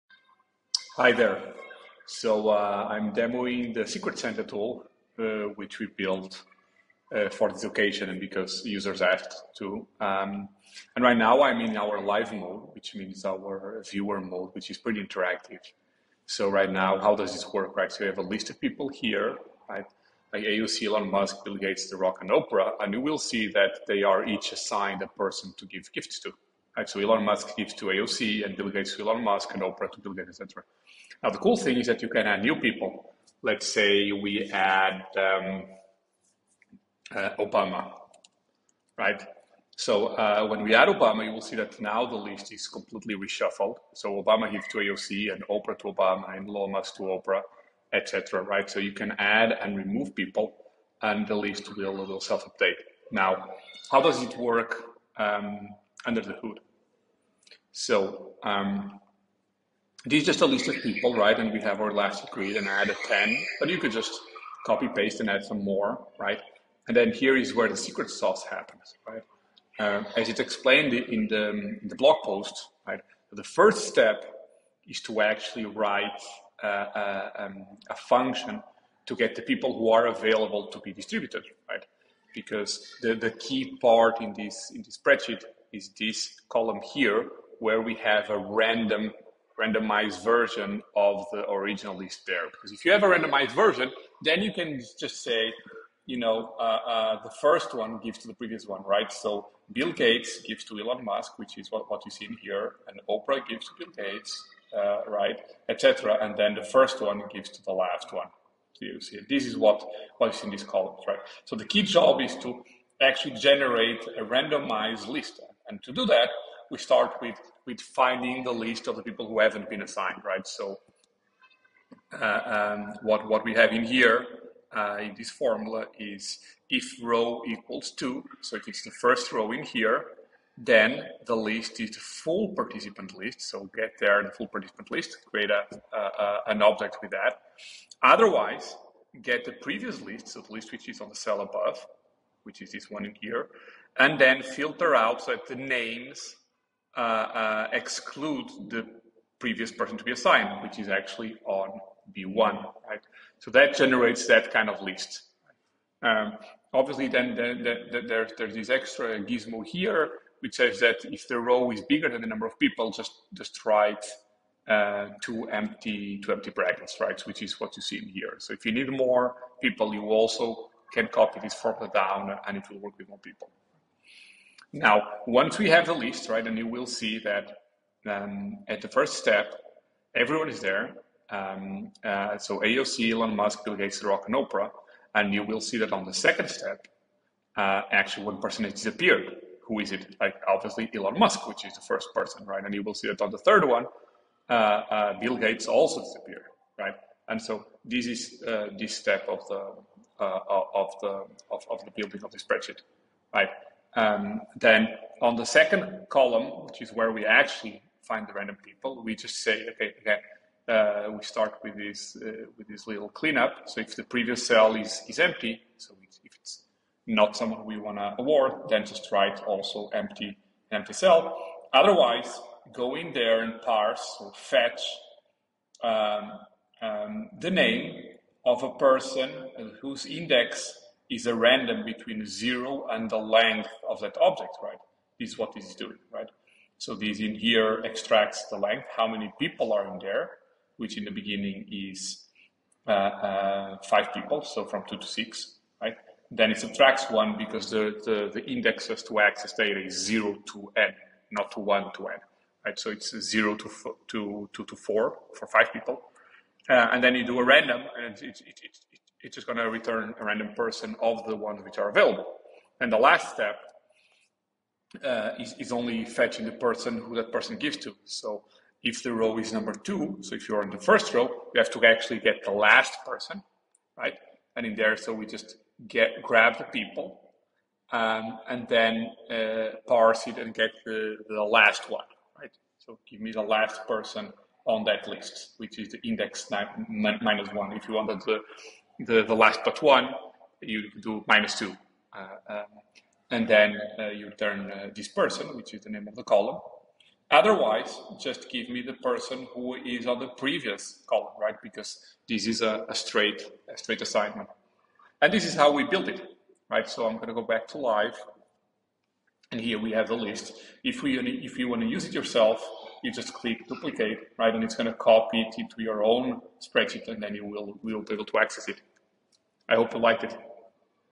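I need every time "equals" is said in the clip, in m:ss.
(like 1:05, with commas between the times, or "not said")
2:07.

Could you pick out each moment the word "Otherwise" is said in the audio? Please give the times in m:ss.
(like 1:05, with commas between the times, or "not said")
2:18, 3:41, 4:57.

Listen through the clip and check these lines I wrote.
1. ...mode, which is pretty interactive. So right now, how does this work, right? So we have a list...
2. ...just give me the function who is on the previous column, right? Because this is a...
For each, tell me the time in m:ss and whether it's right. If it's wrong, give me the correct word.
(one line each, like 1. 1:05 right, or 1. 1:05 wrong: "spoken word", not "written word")
1. 0:14 right
2. 4:58 wrong: "person", not "function".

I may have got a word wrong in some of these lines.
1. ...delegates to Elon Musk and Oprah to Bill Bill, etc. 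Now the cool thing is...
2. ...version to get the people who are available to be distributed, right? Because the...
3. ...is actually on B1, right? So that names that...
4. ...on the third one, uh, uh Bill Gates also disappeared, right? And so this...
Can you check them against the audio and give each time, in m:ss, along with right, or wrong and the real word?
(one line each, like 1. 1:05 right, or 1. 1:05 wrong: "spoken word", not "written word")
1. 0:28 wrong: "Gates", not "Bill"
2. 1:17 wrong: "function", not "version"
3. 2:30 wrong: "generates", not "names"
4. 3:13 right.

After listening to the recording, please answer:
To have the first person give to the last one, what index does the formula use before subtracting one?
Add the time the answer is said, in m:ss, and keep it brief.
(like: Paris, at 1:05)
9, at 4:46.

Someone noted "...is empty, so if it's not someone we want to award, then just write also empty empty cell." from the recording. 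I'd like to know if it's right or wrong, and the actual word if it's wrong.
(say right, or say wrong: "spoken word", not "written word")
right.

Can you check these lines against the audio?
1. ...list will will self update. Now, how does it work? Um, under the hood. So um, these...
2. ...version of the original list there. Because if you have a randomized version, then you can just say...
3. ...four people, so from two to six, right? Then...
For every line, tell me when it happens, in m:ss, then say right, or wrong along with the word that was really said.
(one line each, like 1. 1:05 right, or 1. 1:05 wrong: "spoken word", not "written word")
1. 0:51 right
2. 1:30 right
3. 4:03 wrong: "five", not "four".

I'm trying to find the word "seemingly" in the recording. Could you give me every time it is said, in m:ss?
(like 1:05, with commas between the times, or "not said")
not said.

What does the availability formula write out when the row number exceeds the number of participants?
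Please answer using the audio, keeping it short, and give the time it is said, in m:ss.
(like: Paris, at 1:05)
two empty brackets, at 2:46.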